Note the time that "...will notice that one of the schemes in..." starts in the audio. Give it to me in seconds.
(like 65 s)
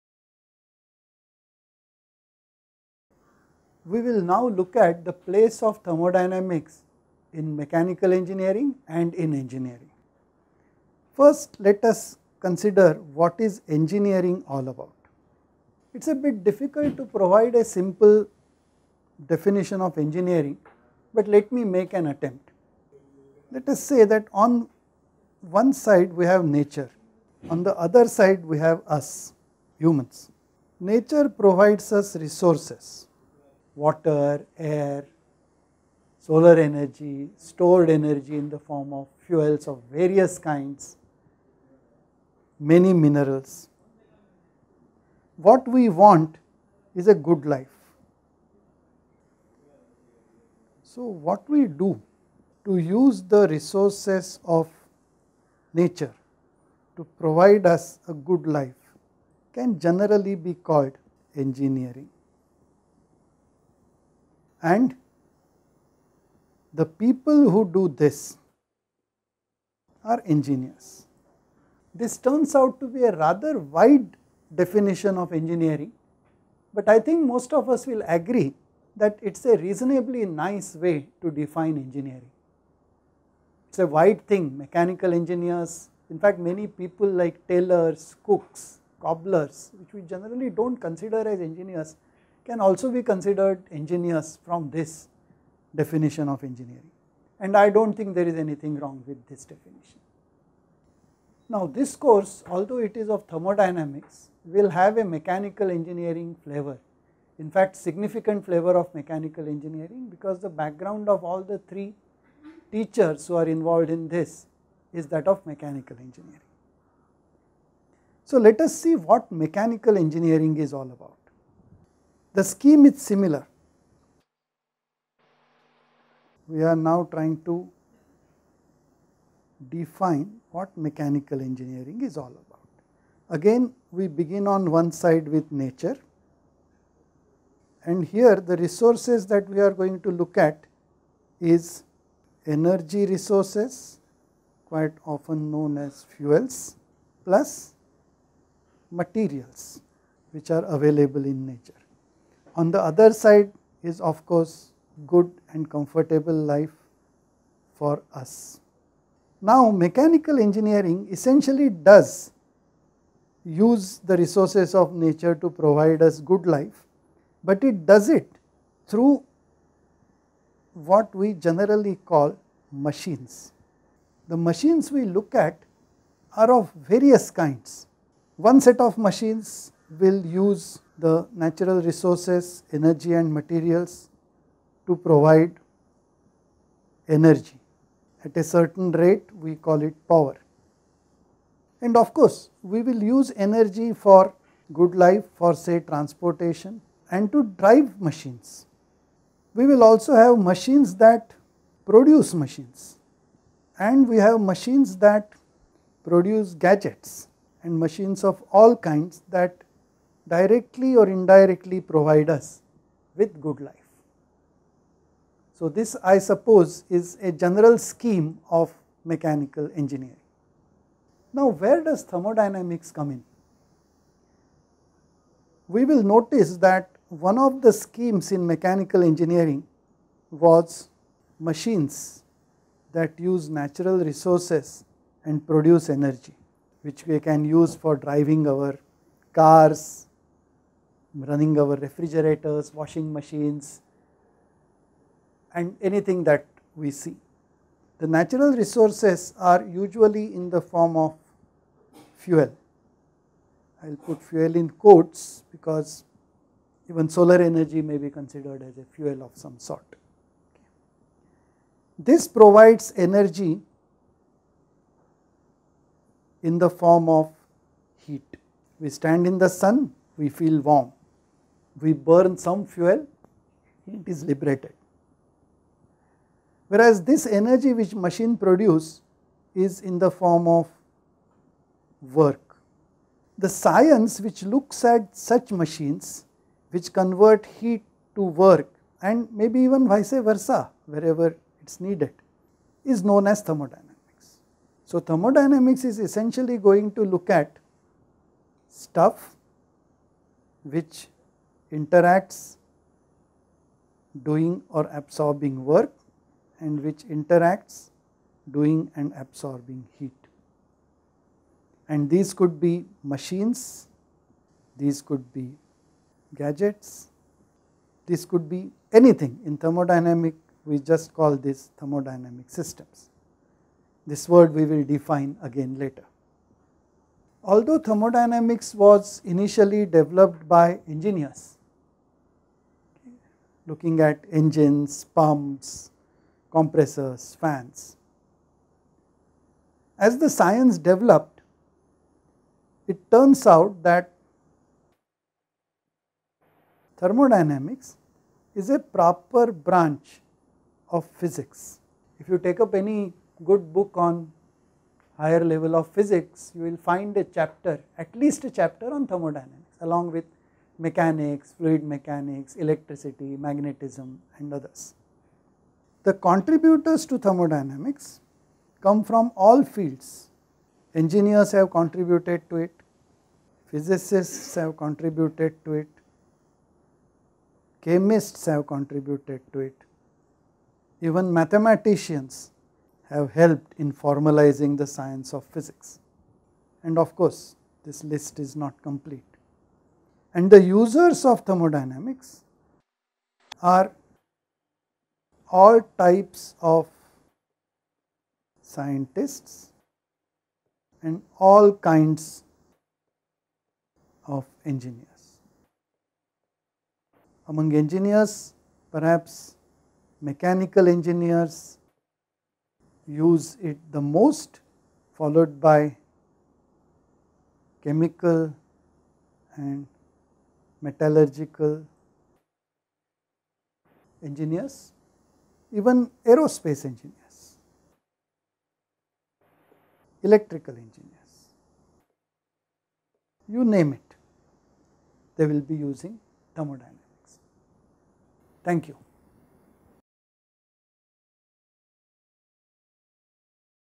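225 s.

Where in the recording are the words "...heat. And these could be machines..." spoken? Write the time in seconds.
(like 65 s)
309 s.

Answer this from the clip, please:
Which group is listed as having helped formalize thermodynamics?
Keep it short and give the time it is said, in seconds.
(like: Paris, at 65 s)
Mathematicians, at 381 s.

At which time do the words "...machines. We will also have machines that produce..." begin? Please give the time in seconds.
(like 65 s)
197 s.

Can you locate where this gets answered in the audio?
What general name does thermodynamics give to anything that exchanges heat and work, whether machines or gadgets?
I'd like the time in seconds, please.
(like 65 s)
321 s.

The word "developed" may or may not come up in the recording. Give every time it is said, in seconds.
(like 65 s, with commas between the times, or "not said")
329 s, 340 s.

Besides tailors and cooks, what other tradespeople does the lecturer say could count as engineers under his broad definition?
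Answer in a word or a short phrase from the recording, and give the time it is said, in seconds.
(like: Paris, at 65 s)
Cobblers, at 88 s.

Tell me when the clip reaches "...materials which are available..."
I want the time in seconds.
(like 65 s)
148 s.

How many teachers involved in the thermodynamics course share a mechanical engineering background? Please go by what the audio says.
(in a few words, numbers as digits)
3.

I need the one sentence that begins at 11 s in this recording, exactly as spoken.
First, let us consider what is engineering all about.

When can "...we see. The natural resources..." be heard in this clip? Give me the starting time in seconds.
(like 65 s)
246 s.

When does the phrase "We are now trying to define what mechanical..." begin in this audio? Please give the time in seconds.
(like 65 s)
126 s.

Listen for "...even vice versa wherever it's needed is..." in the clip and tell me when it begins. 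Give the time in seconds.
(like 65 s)
289 s.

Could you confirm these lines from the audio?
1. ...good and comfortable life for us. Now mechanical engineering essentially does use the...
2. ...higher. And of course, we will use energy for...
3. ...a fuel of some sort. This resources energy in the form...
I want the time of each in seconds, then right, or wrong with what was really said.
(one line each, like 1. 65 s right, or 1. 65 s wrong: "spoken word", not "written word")
1. 155 s right
2. 190 s wrong: "power", not "higher"
3. 258 s wrong: "provides", not "resources".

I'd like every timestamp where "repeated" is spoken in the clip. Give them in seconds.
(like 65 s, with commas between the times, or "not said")
not said.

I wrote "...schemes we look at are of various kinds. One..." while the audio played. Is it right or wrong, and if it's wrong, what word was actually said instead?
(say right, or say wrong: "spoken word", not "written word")
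wrong: "machines", not "schemes".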